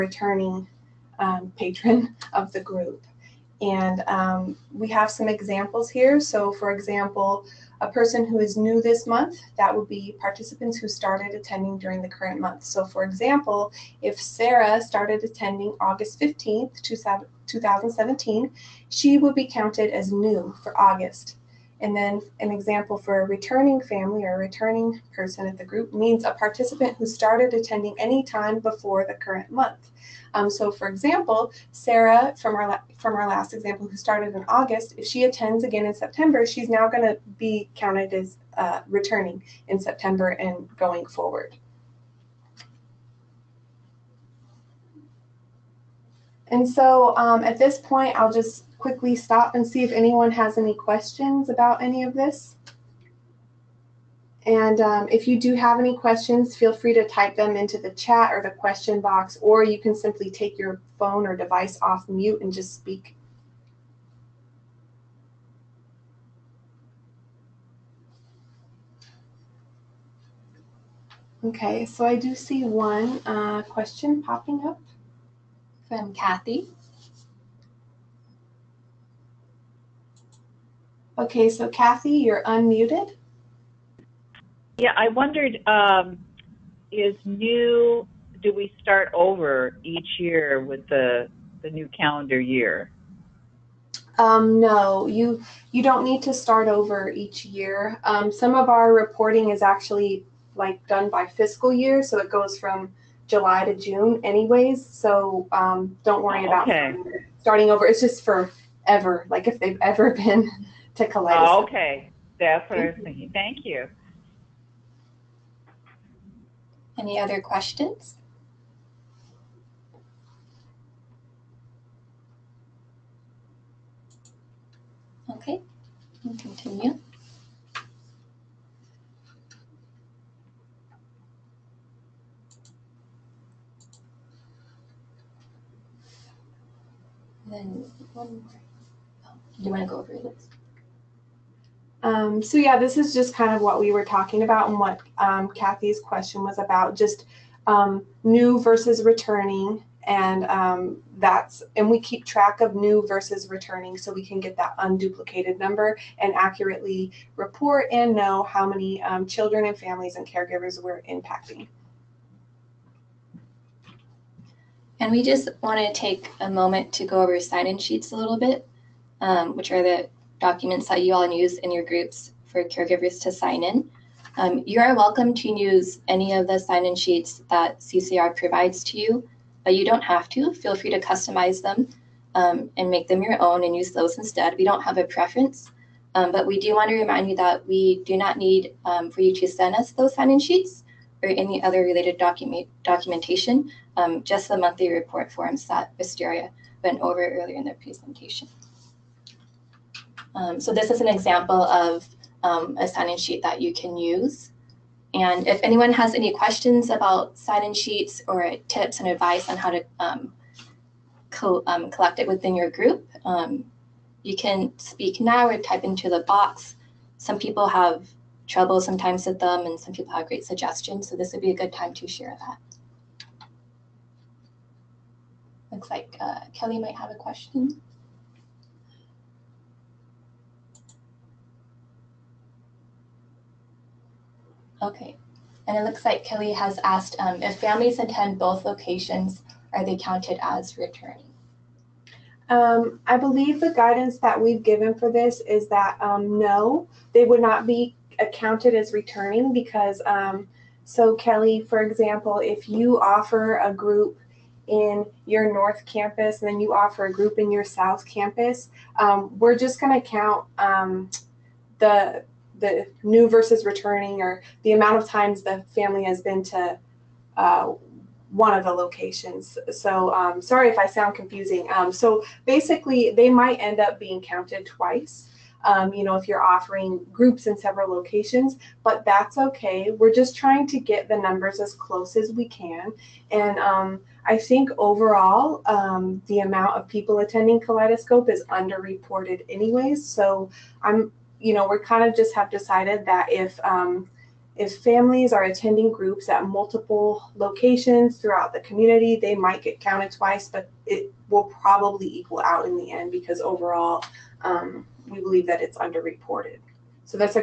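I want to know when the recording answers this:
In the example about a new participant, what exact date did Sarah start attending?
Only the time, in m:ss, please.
0:15.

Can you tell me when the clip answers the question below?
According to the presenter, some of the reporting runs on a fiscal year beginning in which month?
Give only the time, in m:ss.
1:43.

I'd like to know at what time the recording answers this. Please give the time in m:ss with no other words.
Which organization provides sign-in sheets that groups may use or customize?
2:57.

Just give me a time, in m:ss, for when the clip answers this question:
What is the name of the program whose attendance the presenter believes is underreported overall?
4:47.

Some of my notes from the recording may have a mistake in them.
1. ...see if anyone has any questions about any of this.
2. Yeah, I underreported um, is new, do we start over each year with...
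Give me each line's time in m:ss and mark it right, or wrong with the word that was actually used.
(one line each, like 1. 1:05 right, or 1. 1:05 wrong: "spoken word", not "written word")
1. 0:49 right
2. 1:24 wrong: "wondered", not "underreported".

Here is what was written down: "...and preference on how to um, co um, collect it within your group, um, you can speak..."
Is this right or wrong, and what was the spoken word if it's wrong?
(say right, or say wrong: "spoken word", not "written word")
wrong: "advice", not "preference".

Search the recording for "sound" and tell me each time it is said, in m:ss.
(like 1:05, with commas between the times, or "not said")
4:30.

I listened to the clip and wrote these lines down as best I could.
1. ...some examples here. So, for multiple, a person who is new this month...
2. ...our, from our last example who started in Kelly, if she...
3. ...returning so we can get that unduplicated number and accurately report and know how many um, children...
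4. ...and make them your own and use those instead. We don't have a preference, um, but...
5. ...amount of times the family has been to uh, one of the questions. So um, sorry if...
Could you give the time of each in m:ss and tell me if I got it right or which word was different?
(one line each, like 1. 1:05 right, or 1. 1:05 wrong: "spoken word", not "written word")
1. 0:05 wrong: "example", not "multiple"
2. 0:32 wrong: "August", not "Kelly"
3. 2:33 right
4. 3:02 right
5. 4:24 wrong: "locations", not "questions".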